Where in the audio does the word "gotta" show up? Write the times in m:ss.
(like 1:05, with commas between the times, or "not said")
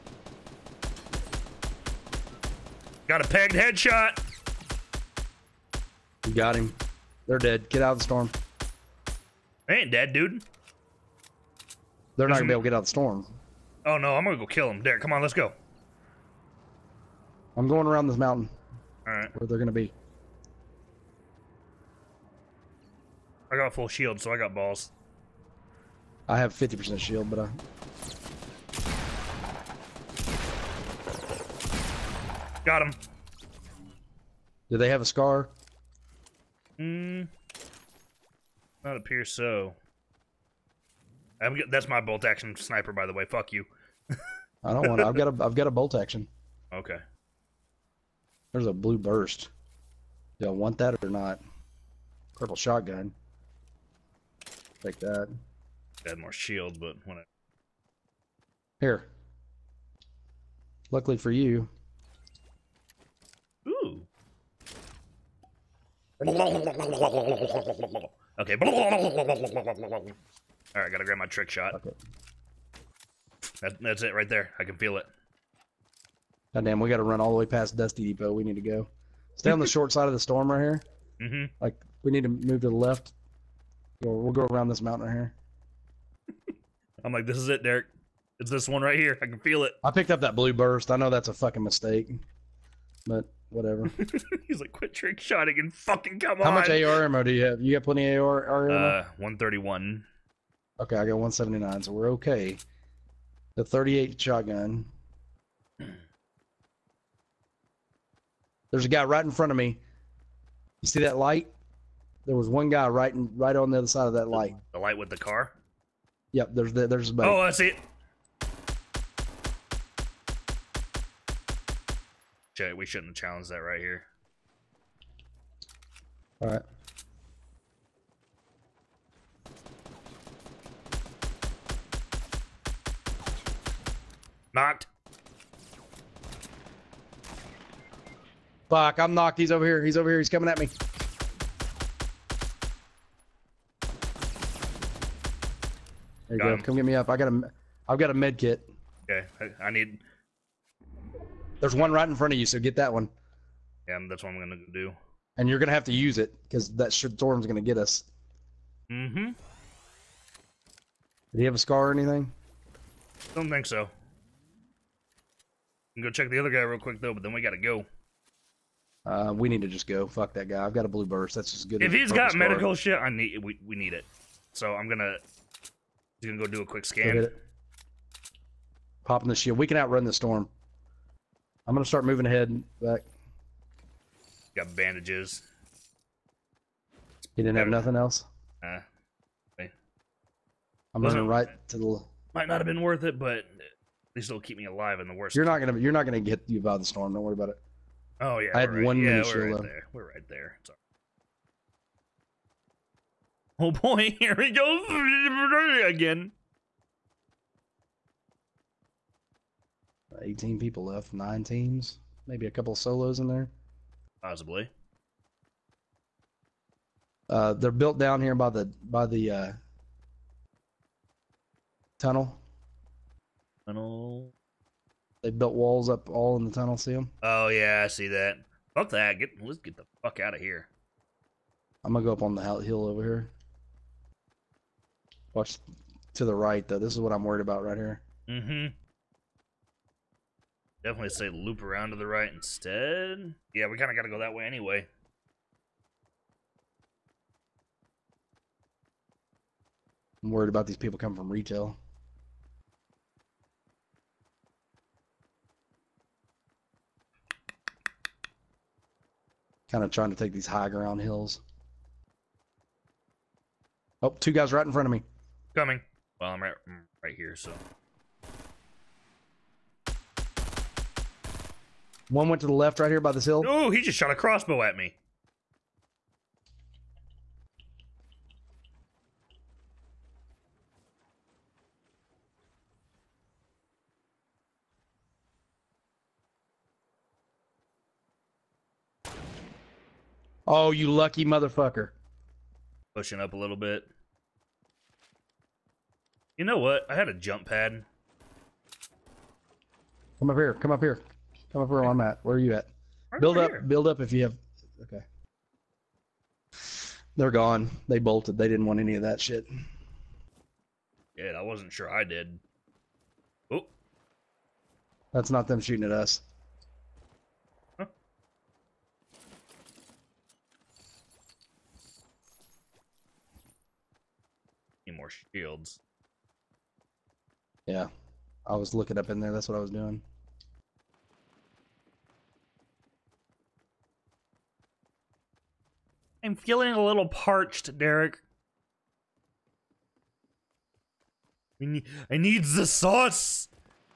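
1:10, 1:16, 2:47.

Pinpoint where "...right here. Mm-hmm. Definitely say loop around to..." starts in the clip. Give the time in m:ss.
3:57.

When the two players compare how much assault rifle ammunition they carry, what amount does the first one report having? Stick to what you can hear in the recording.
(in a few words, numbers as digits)
131.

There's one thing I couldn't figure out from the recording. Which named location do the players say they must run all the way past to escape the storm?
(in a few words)
Dusty Depot.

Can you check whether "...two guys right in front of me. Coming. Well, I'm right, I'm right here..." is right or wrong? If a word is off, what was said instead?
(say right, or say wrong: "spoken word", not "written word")
right.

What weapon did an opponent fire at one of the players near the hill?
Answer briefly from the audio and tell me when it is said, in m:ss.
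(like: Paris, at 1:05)
Crossbow, at 4:34.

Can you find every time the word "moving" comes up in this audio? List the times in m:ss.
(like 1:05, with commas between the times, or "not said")
3:02, 3:11.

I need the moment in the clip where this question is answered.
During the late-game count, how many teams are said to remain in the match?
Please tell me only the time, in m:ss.
3:31.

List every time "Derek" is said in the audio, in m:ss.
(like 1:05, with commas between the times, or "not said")
0:14, 1:27, 5:37.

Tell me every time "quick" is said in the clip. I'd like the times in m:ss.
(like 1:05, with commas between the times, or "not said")
2:46, 2:56.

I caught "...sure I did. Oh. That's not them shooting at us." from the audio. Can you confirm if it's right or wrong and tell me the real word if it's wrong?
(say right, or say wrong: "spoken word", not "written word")
right.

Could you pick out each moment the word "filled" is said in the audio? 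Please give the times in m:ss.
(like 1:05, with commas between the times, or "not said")
not said.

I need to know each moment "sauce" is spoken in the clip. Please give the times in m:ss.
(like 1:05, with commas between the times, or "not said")
5:42.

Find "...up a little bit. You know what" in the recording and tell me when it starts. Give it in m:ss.
4:53.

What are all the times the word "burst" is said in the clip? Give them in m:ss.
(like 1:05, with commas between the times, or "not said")
0:48, 1:30, 2:51.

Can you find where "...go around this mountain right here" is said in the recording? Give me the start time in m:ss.
1:24.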